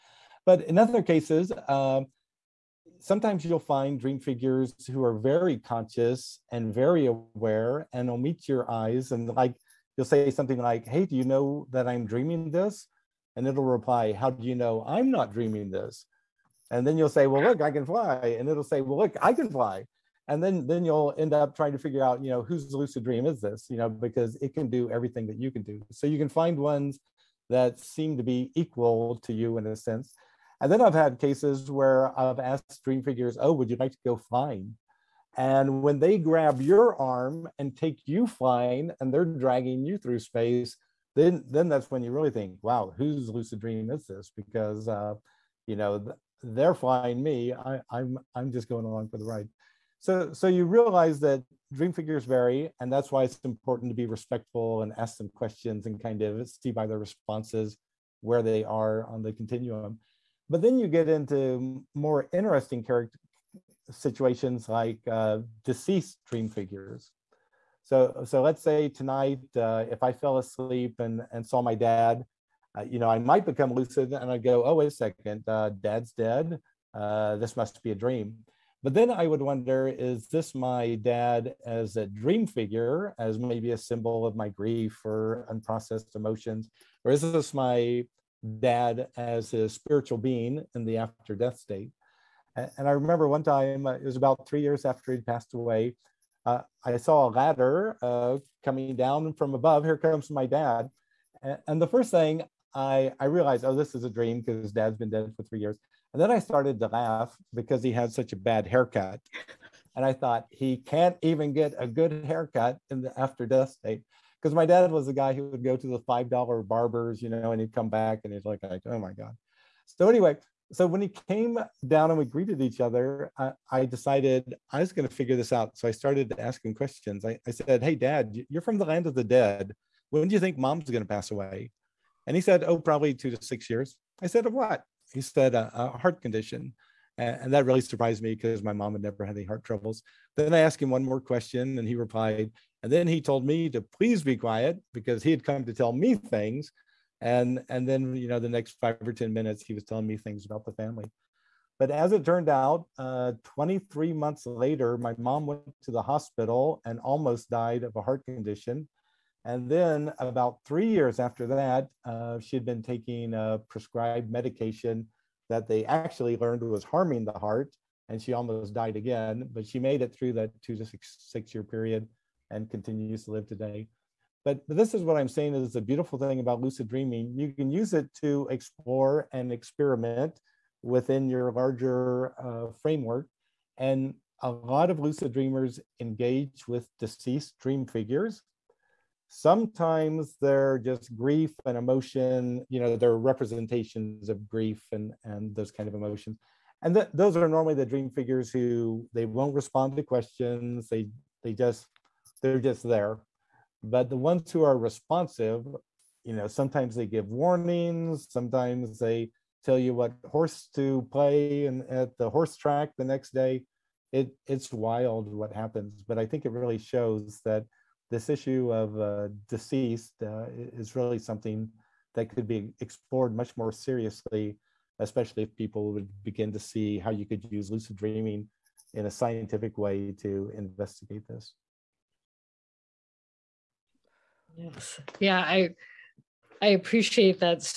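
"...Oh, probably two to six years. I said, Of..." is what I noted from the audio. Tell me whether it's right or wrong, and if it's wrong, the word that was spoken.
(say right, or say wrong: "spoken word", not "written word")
right.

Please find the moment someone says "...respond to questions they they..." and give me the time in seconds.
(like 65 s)
199 s.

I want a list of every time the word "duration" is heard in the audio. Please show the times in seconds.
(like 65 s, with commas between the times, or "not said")
not said.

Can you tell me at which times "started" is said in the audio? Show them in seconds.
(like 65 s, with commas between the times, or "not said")
106 s, 125 s.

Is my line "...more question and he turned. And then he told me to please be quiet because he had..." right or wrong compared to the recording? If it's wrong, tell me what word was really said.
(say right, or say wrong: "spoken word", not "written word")
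wrong: "replied", not "turned".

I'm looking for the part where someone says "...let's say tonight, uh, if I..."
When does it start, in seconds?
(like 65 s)
68 s.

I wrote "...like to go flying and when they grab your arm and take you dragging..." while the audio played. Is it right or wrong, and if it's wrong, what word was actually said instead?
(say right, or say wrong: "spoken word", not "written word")
wrong: "flying", not "dragging".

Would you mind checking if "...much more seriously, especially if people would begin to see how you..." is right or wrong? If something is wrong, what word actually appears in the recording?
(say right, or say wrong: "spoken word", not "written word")
right.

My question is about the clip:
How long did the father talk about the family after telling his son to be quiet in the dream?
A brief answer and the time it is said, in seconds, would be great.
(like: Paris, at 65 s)
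5 or 10 minutes, at 148 s.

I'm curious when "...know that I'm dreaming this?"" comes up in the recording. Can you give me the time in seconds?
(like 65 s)
11 s.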